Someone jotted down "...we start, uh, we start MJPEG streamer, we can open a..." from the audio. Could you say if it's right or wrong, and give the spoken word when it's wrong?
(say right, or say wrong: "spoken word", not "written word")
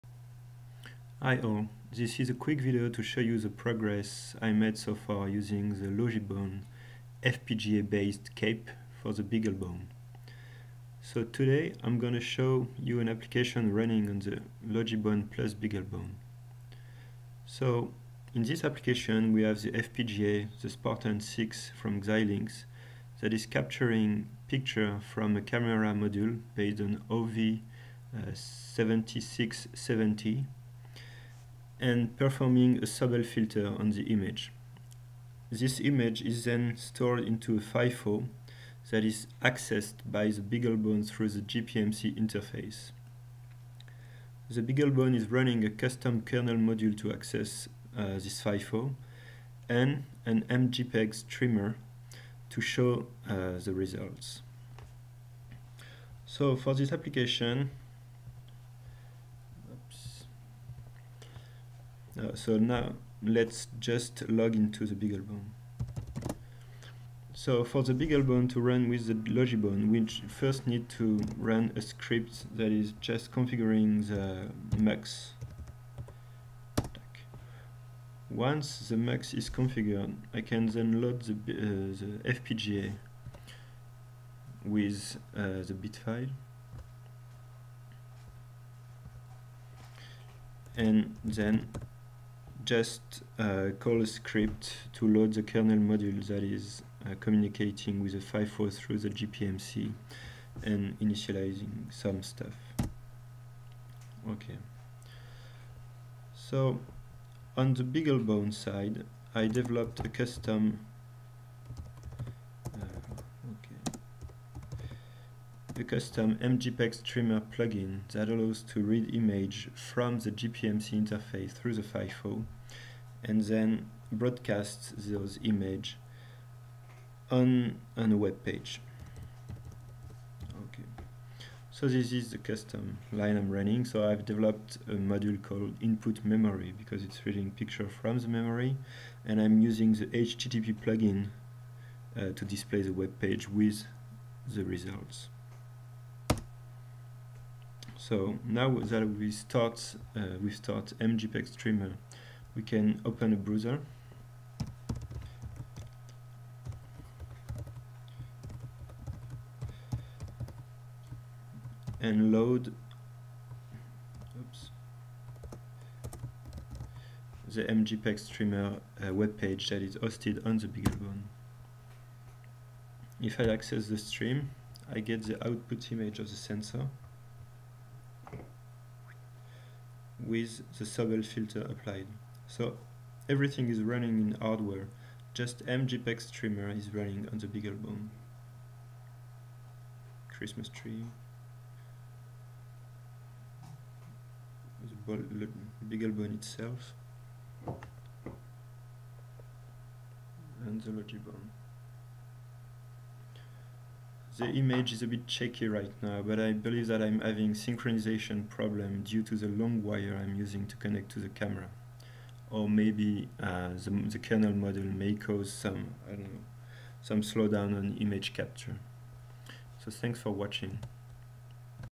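right.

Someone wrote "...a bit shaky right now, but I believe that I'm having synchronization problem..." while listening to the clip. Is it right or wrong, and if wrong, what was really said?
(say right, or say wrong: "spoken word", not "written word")
right.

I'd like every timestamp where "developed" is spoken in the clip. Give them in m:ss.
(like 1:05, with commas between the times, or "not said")
1:49, 2:14.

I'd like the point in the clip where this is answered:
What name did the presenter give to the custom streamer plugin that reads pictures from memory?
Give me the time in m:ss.
2:15.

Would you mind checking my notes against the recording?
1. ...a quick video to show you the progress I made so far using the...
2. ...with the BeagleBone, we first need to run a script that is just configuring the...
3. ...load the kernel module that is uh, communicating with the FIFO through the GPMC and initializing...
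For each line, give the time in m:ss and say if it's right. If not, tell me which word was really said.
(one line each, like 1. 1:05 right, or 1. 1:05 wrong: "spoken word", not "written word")
1. 0:02 right
2. 1:08 wrong: "Logibone", not "BeagleBone"
3. 1:35 right.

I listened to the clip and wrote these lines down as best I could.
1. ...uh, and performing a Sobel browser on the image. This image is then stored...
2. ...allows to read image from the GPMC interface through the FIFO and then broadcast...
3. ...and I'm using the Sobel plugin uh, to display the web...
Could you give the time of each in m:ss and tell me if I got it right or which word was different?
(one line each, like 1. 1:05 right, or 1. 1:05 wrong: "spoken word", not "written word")
1. 0:30 wrong: "filter", not "browser"
2. 1:58 right
3. 2:19 wrong: "HTTP", not "Sobel".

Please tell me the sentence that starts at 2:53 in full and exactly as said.
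If I access the stream, I get the output image of the sensor with the Sobel filter applied.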